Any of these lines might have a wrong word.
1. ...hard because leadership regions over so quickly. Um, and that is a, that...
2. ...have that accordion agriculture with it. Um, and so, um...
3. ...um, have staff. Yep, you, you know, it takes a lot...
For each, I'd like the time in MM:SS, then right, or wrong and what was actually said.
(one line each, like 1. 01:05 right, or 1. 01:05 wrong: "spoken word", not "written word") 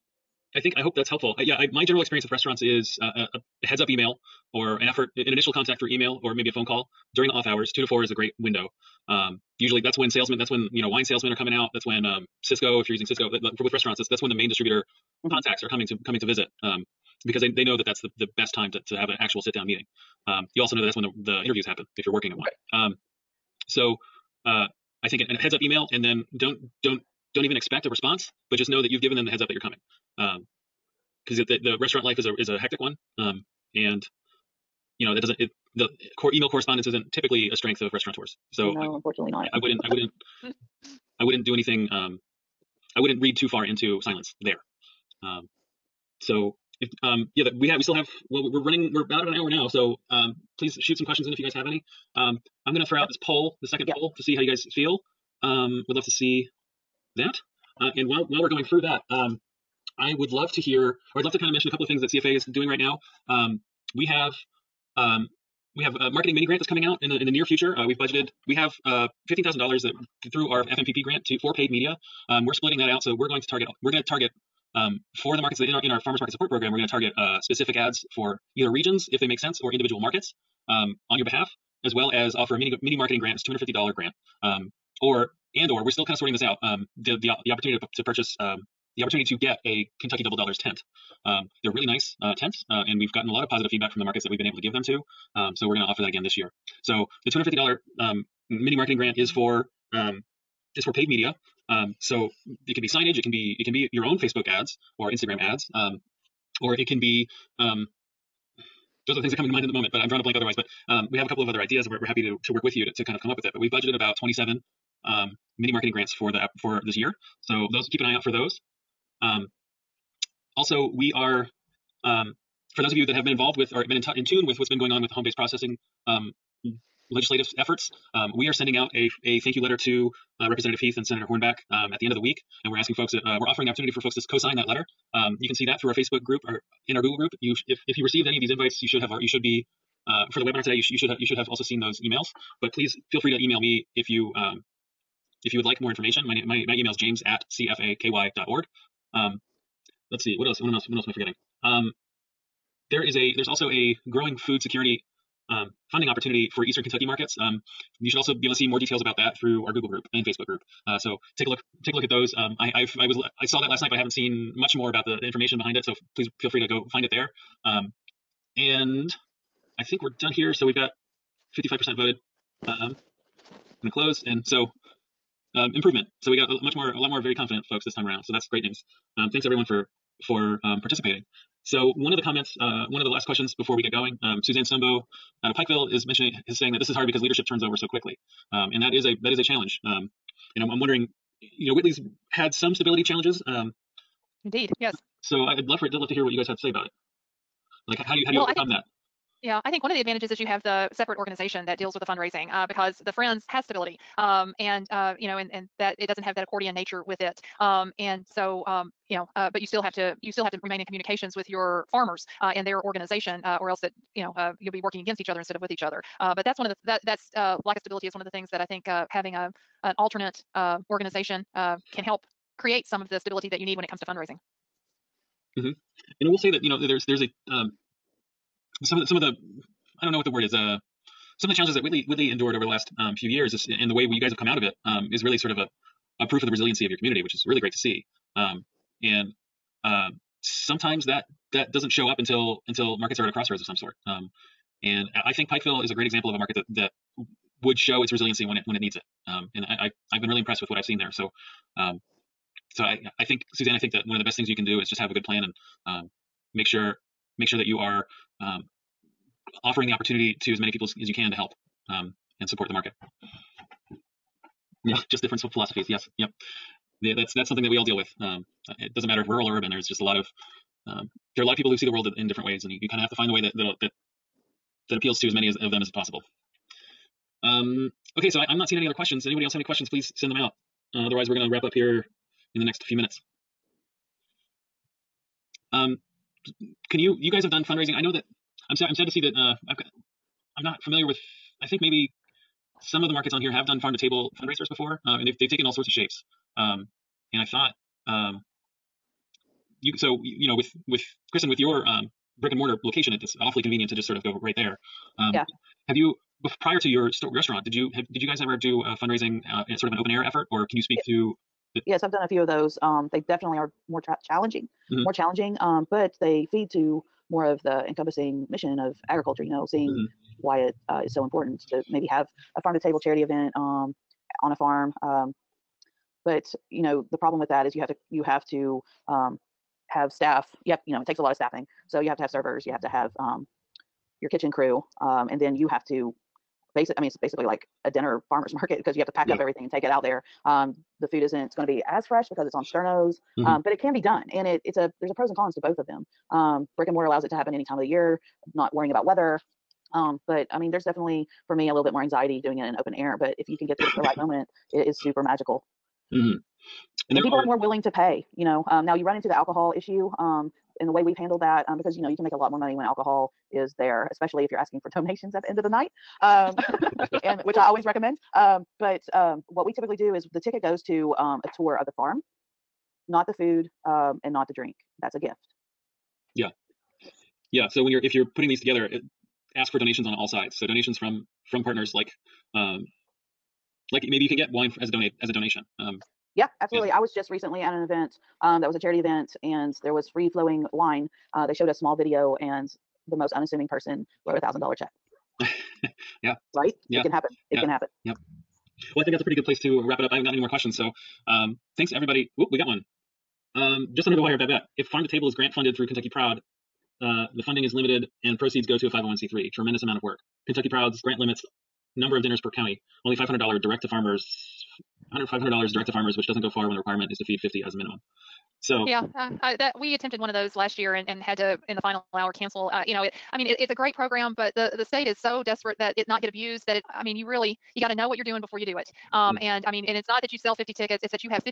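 1. 03:06 wrong: "turns", not "regions"
2. 03:26 wrong: "nature", not "agriculture"
3. 05:29 right.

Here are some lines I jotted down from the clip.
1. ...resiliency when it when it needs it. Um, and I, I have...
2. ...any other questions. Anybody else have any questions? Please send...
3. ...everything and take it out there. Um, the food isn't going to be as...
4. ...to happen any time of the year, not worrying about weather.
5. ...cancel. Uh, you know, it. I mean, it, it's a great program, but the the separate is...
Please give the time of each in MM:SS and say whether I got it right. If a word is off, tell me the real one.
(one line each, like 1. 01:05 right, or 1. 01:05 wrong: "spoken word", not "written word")
1. 04:08 right
2. 04:38 right
3. 05:39 right
4. 05:47 right
5. 07:02 wrong: "state", not "separate".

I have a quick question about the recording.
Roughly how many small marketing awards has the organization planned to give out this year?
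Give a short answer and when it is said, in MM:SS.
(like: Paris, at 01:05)
27, at 01:54.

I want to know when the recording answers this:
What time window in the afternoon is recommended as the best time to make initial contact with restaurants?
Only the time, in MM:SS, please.
00:07.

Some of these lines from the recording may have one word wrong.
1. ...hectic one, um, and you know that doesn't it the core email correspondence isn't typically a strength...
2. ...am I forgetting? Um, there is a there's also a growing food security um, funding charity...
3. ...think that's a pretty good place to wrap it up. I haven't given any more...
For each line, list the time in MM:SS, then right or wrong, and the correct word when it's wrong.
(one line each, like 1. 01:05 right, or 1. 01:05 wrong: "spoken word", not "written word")
1. 00:32 right
2. 02:31 wrong: "opportunity", not "charity"
3. 06:39 wrong: "gotten", not "given".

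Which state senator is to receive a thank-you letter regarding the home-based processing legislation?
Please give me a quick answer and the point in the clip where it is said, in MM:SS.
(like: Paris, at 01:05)
Senator Hornback, at 02:11.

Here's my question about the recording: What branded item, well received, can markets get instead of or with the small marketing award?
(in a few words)
Kentucky Double Dollars tent.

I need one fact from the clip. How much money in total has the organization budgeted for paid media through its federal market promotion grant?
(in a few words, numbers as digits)
$15,000.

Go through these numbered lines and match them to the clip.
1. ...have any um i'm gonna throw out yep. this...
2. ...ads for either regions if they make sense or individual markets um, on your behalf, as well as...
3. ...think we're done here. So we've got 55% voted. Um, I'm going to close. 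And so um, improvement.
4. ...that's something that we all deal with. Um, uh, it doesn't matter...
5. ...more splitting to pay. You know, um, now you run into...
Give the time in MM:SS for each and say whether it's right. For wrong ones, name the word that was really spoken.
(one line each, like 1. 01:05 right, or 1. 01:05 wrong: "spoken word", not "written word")
1. 00:51 right
2. 01:17 right
3. 02:49 right
4. 04:27 right
5. 05:57 wrong: "willing", not "splitting".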